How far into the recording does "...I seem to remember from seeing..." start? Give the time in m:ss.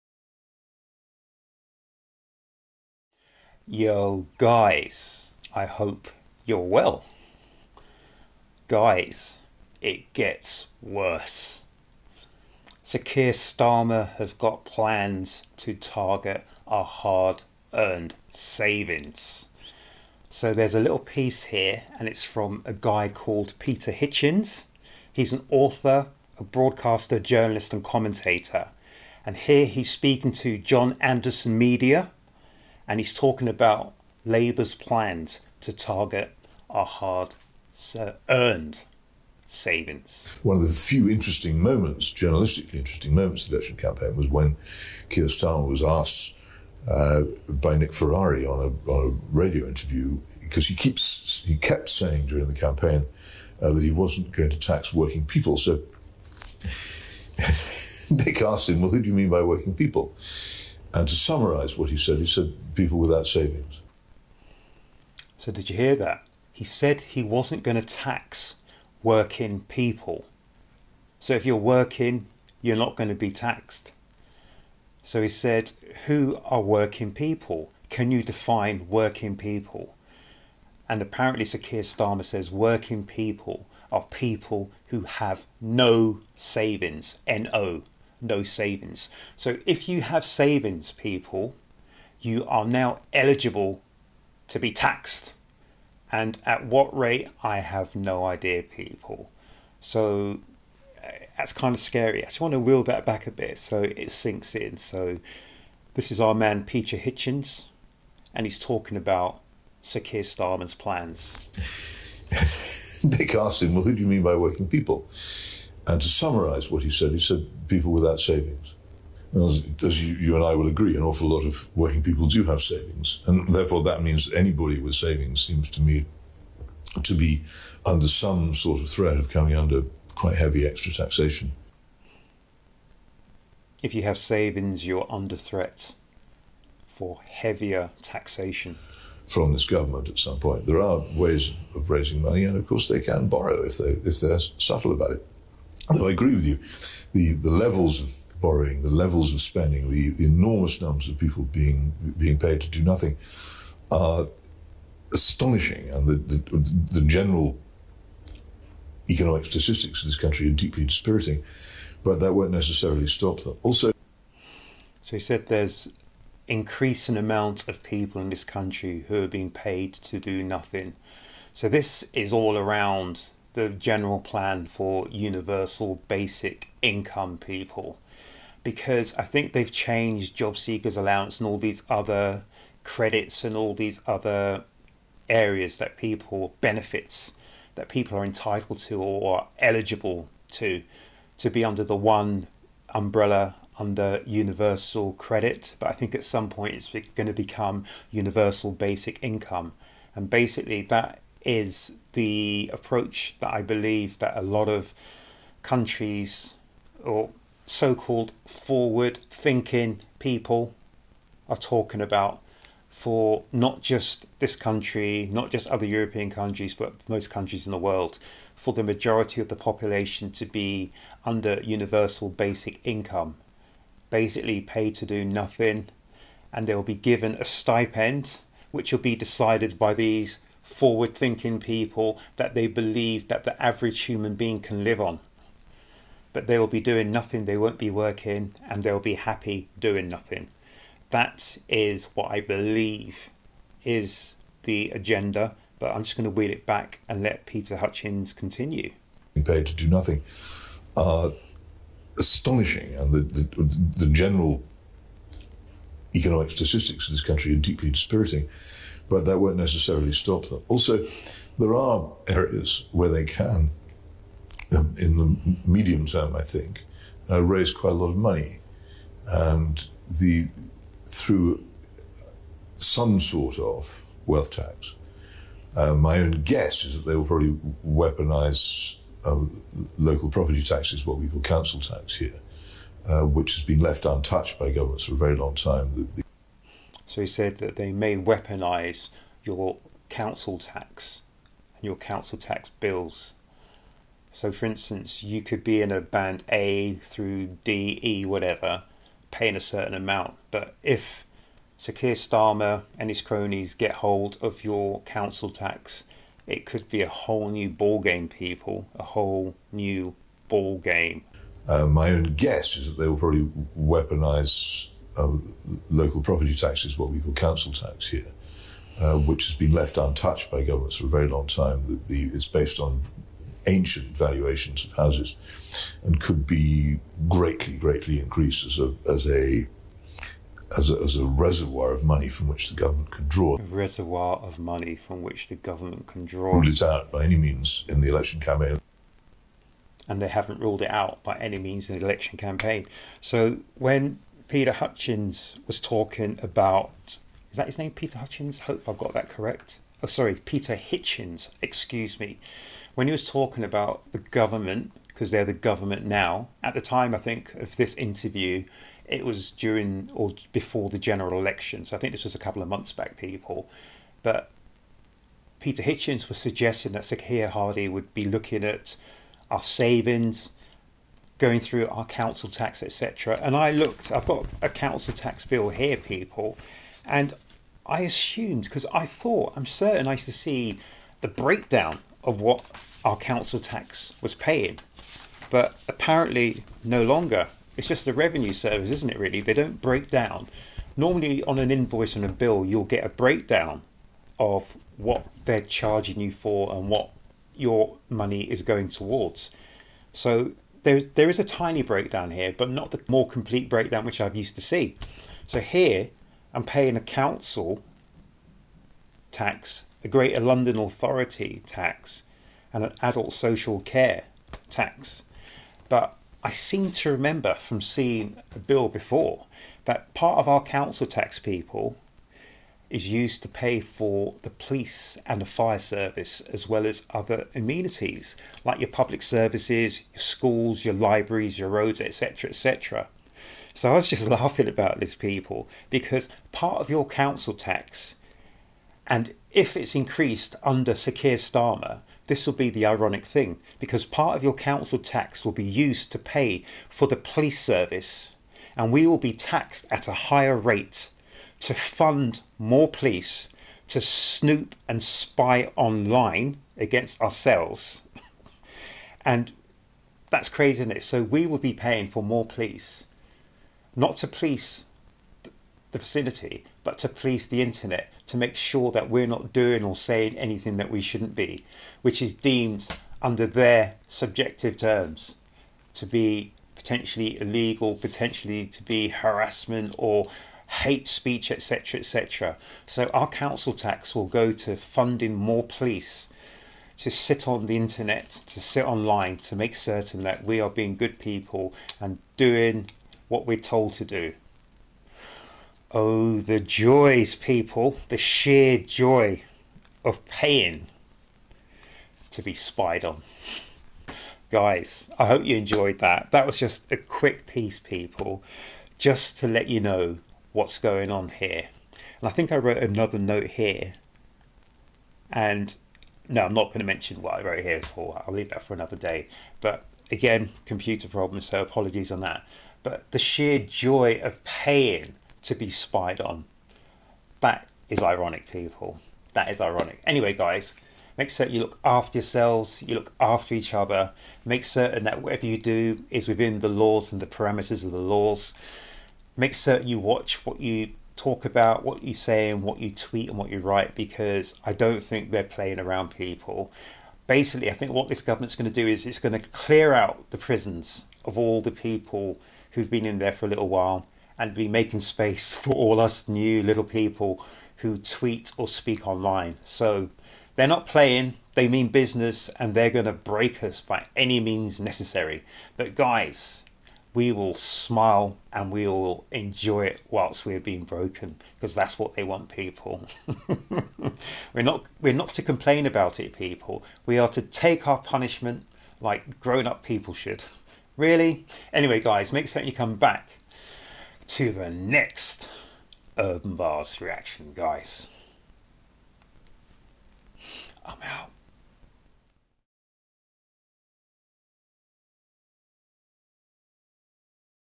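6:56.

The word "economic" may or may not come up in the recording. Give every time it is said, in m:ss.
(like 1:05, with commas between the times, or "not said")
2:39, 4:16.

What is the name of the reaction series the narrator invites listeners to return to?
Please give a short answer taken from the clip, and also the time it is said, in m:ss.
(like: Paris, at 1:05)
Urb'n Barz, at 9:46.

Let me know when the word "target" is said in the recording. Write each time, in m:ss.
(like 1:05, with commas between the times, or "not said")
0:15, 0:35.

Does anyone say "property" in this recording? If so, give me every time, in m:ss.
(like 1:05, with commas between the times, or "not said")
4:40, 5:16.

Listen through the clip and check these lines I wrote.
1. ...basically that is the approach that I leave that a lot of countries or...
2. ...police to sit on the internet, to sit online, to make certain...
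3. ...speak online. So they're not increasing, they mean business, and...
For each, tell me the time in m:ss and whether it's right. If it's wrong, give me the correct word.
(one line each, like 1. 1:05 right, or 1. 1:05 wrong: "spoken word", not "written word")
1. 3:20 wrong: "believe", not "leave"
2. 8:05 right
3. 9:18 wrong: "playing", not "increasing".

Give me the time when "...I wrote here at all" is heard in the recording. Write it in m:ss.
8:37.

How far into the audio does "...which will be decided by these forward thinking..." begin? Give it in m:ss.
3:48.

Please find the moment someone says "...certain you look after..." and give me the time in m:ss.
8:51.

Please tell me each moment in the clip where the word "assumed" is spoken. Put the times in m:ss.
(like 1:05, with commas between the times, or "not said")
6:18.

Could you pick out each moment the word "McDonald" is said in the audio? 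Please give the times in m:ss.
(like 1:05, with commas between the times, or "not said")
not said.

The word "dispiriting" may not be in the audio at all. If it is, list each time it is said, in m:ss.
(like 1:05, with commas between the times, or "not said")
2:40, 4:17.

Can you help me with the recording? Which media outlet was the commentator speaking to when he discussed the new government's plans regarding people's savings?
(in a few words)
John Anderson Media.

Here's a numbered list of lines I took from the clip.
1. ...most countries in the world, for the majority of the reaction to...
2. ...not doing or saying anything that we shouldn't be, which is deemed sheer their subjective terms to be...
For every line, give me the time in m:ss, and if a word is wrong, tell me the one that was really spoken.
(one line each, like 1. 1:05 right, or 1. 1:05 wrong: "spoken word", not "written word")
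1. 3:37 wrong: "population", not "reaction"
2. 7:49 wrong: "under", not "sheer".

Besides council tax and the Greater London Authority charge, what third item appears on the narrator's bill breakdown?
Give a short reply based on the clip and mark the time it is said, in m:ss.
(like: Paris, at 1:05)
Adult social care tax, at 6:53.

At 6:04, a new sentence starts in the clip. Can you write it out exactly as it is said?
But Peter Hitchens was suggesting that Sakia Hardy would be looking at our savings, going through our council tax, etc.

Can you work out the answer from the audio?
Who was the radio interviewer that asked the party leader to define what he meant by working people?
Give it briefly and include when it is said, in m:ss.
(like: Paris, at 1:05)
Nick Ferrari, at 0:47.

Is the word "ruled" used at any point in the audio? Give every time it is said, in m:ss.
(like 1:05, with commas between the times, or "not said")
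5:36, 5:40.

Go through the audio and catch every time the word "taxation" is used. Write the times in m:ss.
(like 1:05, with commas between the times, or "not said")
2:10, 2:18.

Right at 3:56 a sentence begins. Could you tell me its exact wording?
But they will be doing nothing, they won't be working, and they'll be happy doing nothing.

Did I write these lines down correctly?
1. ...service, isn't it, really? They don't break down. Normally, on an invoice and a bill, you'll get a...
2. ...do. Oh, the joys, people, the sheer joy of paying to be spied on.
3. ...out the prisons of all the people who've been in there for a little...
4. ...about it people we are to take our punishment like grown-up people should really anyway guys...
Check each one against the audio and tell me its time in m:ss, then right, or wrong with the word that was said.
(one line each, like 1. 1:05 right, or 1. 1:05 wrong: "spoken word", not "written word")
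1. 6:28 right
2. 8:14 right
3. 9:09 right
4. 9:35 right.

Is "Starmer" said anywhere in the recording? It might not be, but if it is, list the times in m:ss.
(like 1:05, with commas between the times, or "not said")
0:13, 0:45, 1:21, 1:50, 5:02, 7:21.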